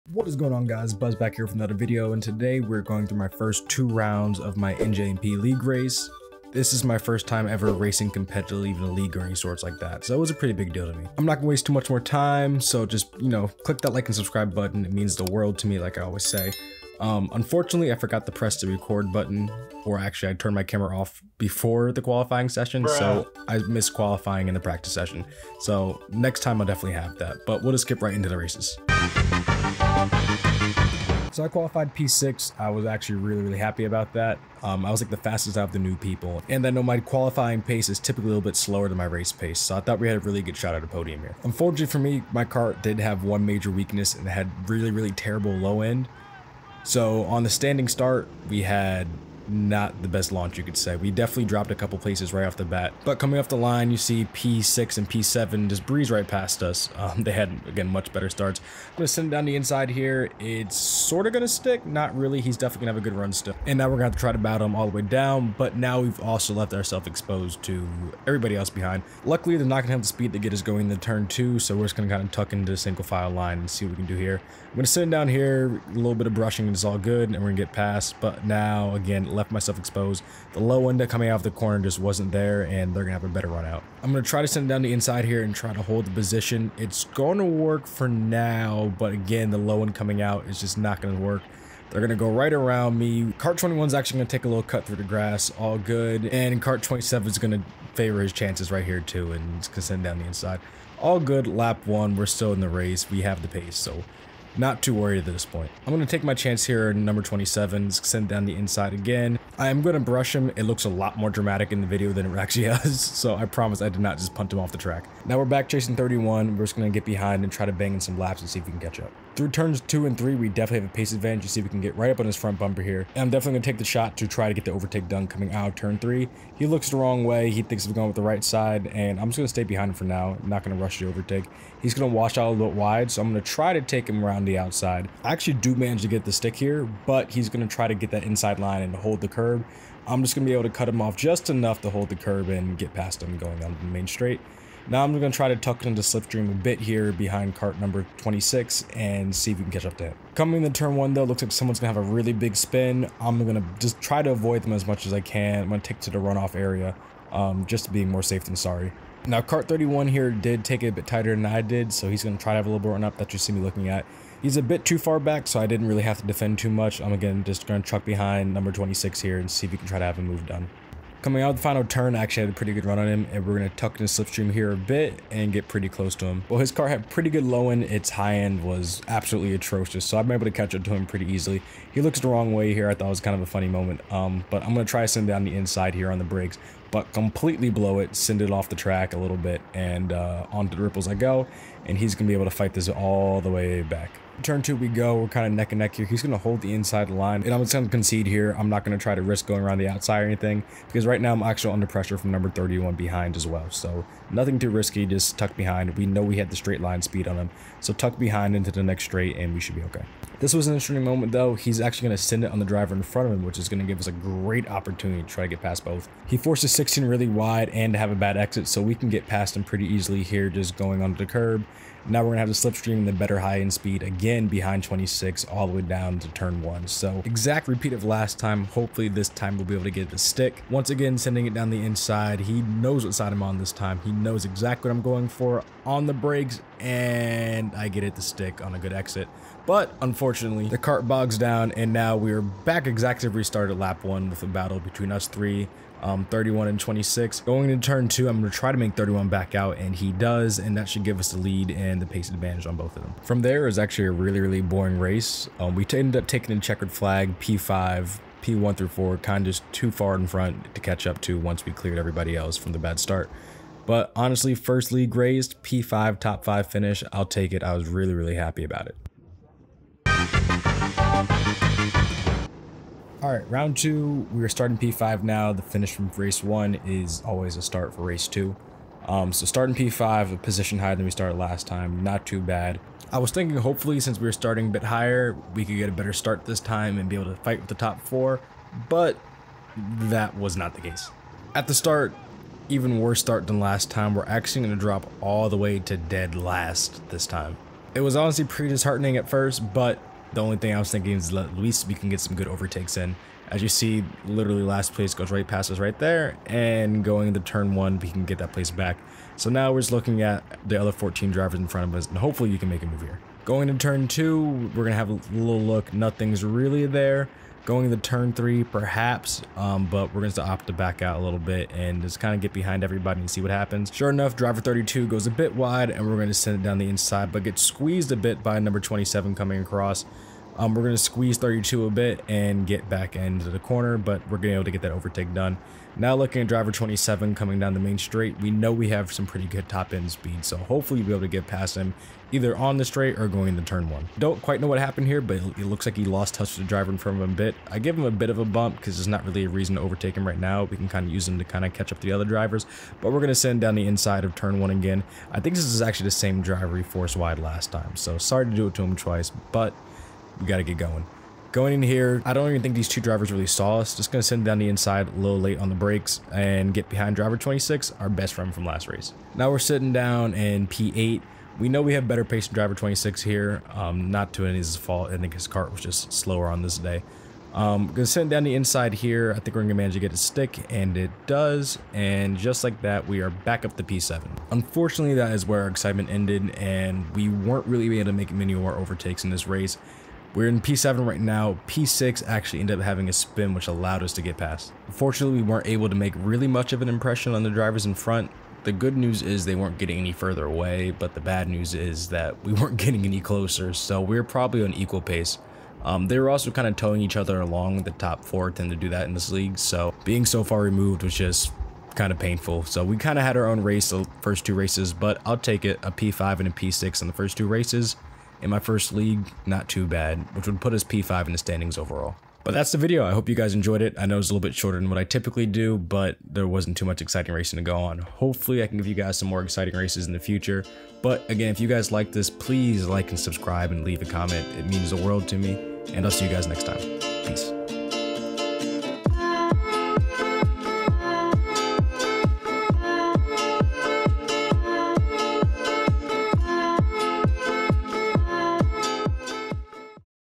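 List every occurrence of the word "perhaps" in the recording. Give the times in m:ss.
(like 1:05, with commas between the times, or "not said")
5:18.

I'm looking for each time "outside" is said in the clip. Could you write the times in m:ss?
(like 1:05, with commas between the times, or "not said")
2:14, 3:19.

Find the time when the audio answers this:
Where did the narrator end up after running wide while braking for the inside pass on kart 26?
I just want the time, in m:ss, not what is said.
3:10.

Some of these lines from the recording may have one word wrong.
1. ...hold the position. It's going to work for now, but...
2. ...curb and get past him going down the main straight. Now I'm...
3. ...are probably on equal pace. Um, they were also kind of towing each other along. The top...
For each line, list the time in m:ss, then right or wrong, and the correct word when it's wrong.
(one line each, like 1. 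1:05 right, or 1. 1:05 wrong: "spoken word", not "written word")
1. 1:25 right
2. 2:22 right
3. 6:44 right.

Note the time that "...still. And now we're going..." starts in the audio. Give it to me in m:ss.
1:03.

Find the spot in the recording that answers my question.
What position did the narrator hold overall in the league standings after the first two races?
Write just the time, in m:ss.
7:00.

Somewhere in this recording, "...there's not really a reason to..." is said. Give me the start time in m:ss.
5:48.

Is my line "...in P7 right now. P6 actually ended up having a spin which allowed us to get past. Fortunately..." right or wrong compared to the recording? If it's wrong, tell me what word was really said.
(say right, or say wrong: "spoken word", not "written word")
right.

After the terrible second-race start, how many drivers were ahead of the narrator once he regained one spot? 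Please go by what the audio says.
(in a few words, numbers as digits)
14.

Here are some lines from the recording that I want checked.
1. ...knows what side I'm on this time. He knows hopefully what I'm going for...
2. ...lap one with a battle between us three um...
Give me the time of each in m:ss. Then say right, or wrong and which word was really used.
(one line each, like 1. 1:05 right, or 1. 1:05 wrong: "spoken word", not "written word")
1. 3:52 wrong: "exactly", not "hopefully"
2. 4:03 right.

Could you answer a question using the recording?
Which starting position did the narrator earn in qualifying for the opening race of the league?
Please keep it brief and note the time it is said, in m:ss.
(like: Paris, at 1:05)
P6, at 0:31.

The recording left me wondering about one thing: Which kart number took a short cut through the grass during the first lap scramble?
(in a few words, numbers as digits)
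21.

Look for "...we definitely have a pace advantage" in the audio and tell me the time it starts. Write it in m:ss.
2:00.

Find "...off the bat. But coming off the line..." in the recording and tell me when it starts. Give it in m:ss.
0:52.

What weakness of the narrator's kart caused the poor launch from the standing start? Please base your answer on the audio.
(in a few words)
Terrible low end.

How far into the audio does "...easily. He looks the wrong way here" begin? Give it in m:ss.
3:01.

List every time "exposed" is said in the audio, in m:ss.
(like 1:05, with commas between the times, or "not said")
1:07, 1:19.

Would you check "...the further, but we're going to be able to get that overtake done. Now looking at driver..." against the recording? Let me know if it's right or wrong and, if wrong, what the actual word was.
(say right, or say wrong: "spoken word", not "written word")
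wrong: "corner", not "further".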